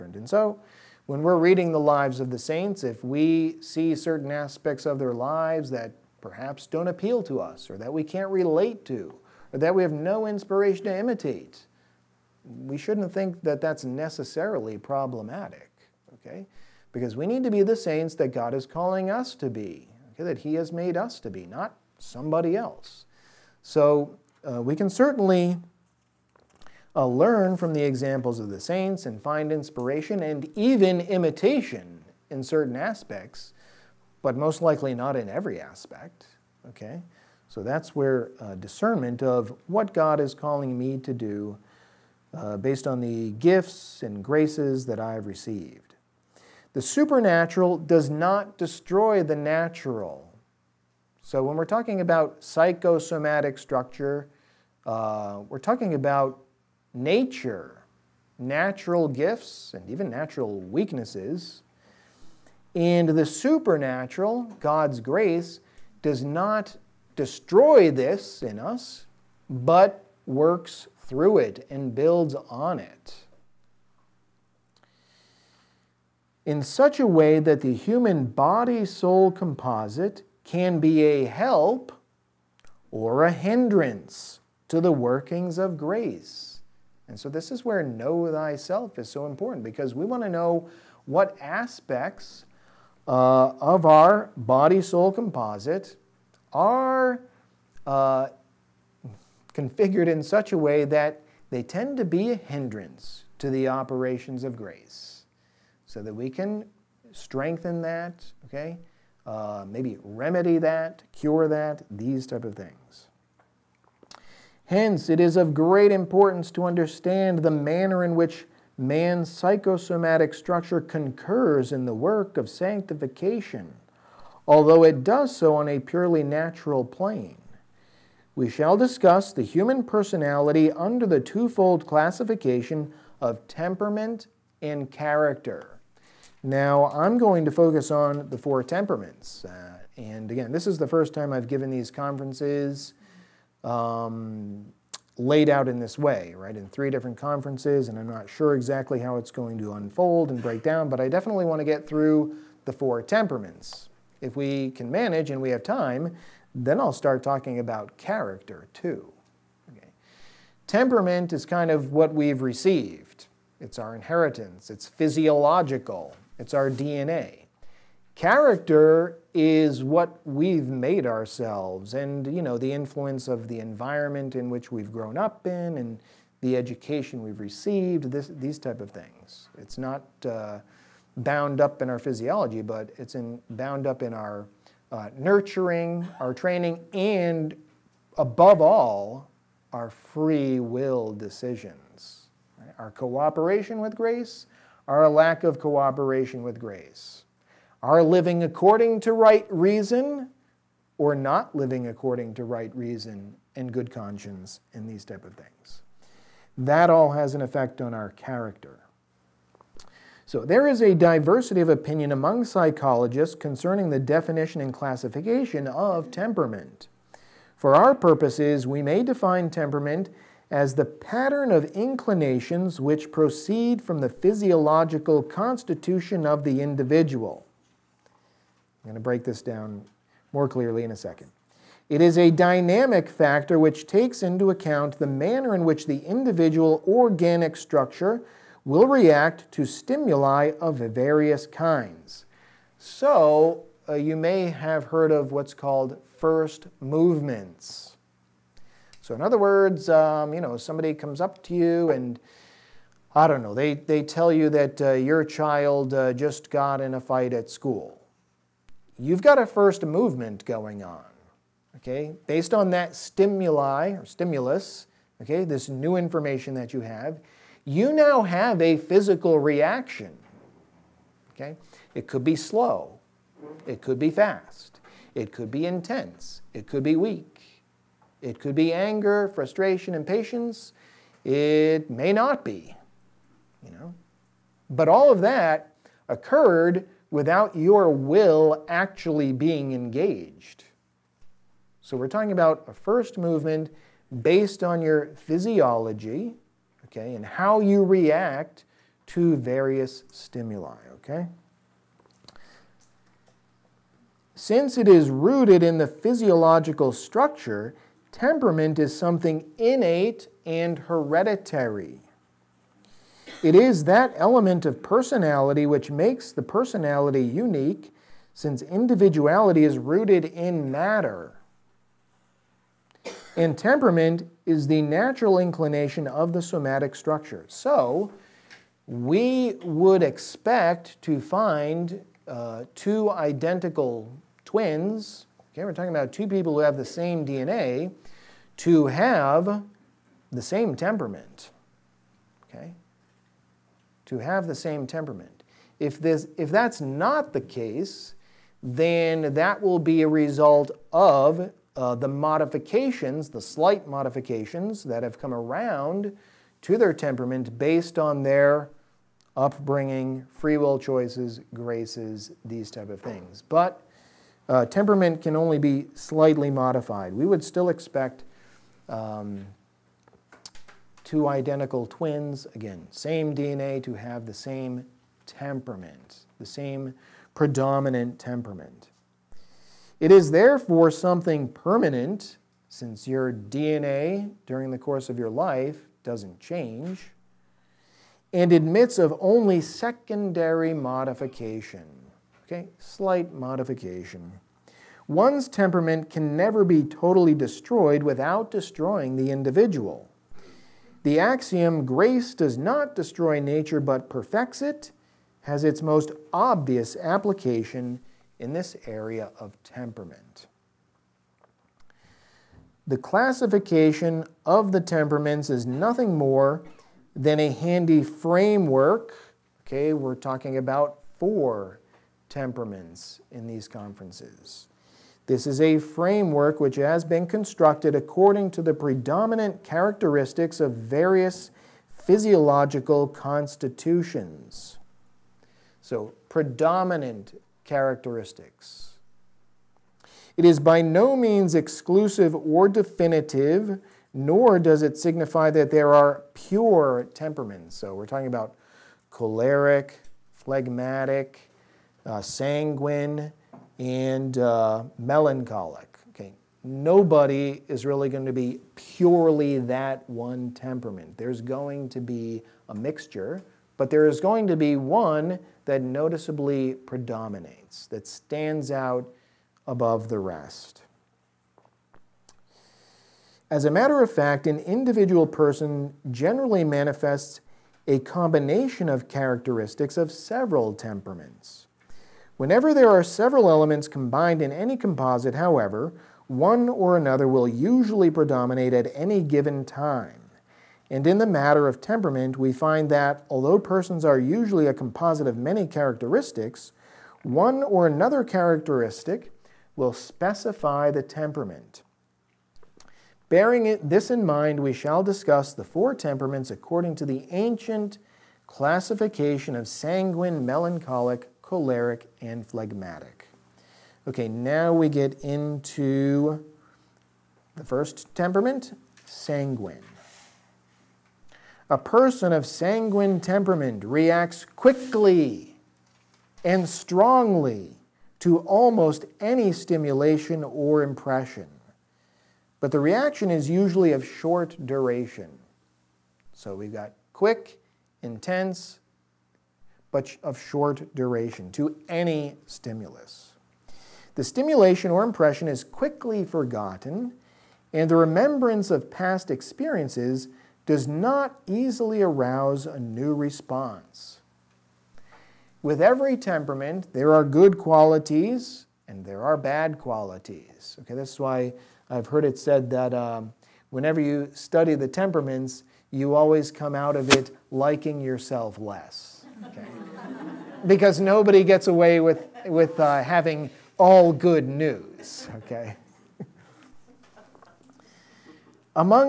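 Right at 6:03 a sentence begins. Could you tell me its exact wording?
But uh, temperament can only be slightly modified.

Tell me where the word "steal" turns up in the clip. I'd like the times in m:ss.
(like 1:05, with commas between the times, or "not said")
not said.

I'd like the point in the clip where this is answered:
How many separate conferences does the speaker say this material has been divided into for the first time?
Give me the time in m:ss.
2:26.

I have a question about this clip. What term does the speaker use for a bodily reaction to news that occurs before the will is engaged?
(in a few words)
First movements.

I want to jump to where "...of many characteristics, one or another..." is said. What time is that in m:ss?
8:15.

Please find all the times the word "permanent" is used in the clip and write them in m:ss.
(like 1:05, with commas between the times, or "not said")
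6:21.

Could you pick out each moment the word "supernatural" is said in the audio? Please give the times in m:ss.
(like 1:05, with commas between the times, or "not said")
0:46, 1:03.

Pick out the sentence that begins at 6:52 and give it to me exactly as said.
The classification of the temperaments is nothing more than a handy framework.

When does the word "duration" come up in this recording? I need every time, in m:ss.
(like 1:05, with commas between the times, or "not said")
8:54, 9:00.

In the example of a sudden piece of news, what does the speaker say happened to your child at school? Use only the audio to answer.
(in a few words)
Got in a fight.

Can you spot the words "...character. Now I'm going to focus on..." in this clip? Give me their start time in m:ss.
2:14.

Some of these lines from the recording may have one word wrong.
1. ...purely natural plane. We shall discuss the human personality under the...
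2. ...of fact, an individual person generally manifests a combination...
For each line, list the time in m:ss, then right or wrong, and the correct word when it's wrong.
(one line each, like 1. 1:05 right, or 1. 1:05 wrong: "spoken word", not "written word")
1. 2:05 right
2. 7:54 right.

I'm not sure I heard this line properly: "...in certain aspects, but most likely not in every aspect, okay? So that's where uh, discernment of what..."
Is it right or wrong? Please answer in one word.
right.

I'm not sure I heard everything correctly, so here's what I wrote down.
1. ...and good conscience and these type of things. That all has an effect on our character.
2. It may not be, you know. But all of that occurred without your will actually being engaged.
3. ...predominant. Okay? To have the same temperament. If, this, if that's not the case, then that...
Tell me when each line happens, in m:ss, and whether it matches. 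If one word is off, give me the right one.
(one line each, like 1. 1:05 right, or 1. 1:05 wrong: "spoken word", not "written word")
1. 3:23 right
2. 4:41 right
3. 5:40 wrong: "temperament", not "predominant".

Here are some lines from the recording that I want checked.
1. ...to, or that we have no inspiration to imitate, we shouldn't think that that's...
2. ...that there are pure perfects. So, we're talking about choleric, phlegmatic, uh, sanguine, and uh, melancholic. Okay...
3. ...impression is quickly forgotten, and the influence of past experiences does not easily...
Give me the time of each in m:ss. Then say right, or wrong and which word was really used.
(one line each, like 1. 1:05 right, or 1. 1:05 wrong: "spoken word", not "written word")
1. 0:08 right
2. 7:25 wrong: "temperaments", not "perfects"
3. 9:05 wrong: "remembrance", not "influence".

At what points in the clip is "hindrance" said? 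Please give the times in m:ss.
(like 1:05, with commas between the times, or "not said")
1:23, 1:42.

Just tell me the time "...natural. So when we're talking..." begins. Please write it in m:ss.
0:49.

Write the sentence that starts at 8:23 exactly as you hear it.
Bearing it, this in mind, we shall discuss the four temperaments according to the ancient classification of sanguine, melancholic, choleric, and phlegmatic.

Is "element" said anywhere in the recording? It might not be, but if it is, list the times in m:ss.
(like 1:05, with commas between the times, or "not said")
5:14, 8:03.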